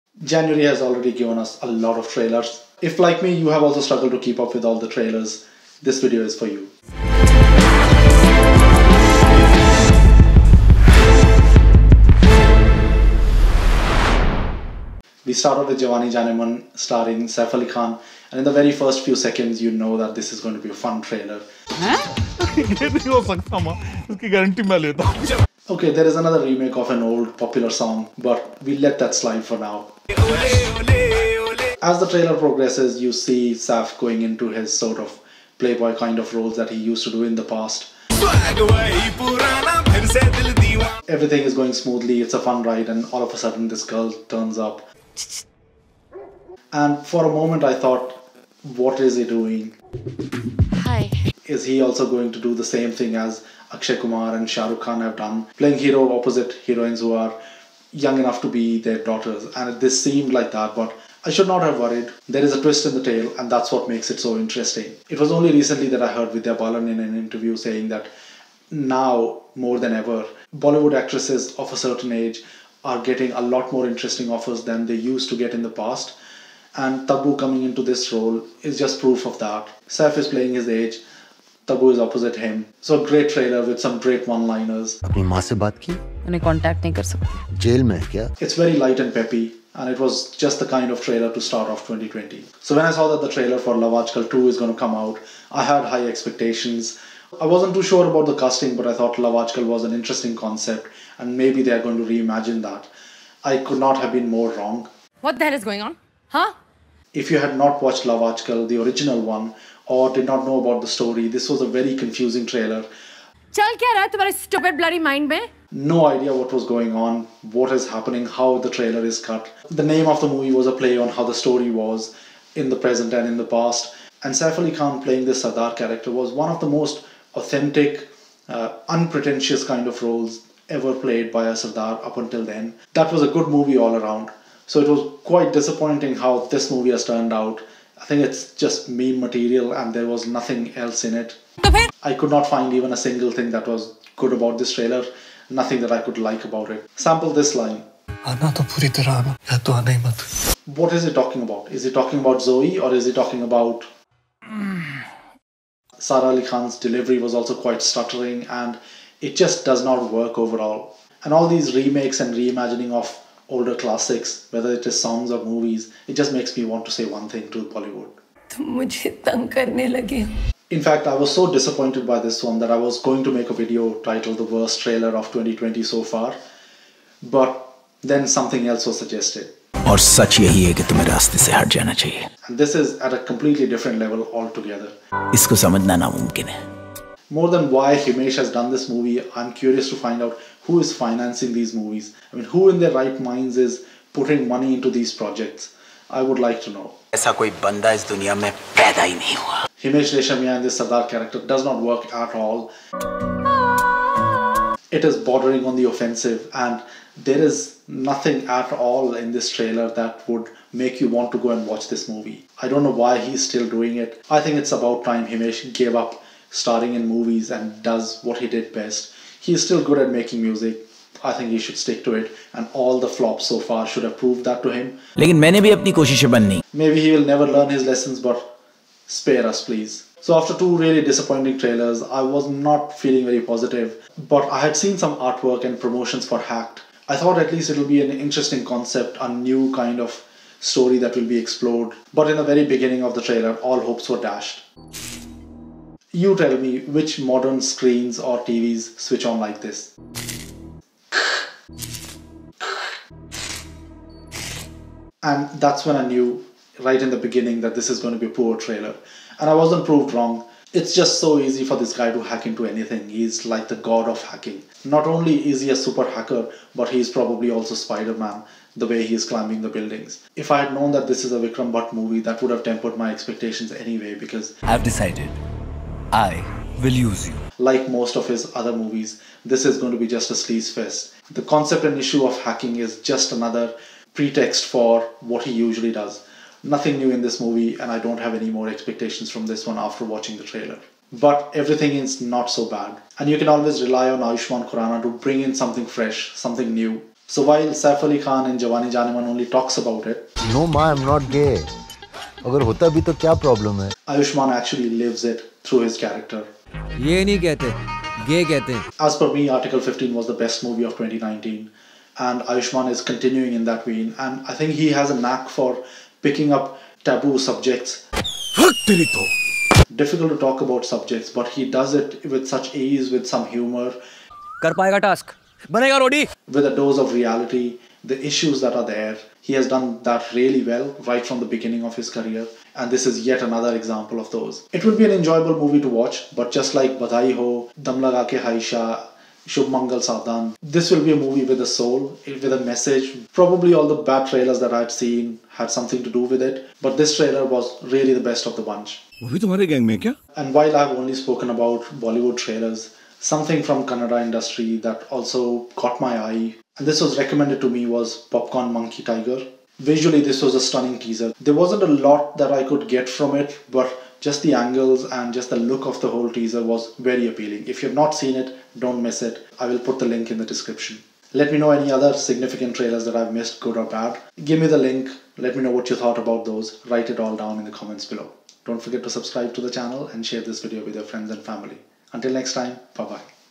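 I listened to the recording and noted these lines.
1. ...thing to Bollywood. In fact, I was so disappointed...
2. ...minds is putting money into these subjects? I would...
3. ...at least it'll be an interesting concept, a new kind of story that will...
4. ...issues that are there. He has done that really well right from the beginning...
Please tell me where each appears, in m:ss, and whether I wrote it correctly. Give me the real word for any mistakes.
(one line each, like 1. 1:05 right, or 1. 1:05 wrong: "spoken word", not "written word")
1. 2:47 right
2. 3:13 wrong: "projects", not "subjects"
3. 3:57 right
4. 5:28 right.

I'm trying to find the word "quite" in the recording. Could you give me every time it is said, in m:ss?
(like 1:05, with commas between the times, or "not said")
2:15, 2:37.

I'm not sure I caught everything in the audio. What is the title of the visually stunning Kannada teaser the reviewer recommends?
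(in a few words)
Popcorn Monkey Tiger.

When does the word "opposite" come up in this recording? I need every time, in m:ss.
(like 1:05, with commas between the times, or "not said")
0:56, 1:21.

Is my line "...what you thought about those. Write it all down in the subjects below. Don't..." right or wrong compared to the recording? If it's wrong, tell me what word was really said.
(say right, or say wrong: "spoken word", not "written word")
wrong: "comments", not "subjects".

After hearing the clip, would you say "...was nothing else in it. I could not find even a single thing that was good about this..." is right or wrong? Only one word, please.
right.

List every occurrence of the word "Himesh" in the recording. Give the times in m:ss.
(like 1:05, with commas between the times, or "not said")
3:07, 3:19, 3:35.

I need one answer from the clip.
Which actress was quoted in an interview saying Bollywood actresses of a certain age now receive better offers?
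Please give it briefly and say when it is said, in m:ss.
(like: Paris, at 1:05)
Vidya Balan, at 1:06.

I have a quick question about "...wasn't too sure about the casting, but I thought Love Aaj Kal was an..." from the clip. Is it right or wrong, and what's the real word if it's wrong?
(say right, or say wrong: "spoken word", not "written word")
right.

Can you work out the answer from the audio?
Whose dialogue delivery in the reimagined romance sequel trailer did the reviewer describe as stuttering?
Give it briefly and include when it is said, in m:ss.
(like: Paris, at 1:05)
Sara Ali Khan, at 2:35.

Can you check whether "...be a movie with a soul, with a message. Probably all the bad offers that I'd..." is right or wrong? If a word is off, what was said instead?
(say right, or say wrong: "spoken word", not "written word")
wrong: "trailers", not "offers".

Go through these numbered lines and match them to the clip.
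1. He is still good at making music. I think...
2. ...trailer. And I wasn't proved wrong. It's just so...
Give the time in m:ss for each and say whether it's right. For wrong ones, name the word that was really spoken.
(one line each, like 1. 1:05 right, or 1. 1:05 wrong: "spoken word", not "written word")
1. 3:39 right
2. 4:18 right.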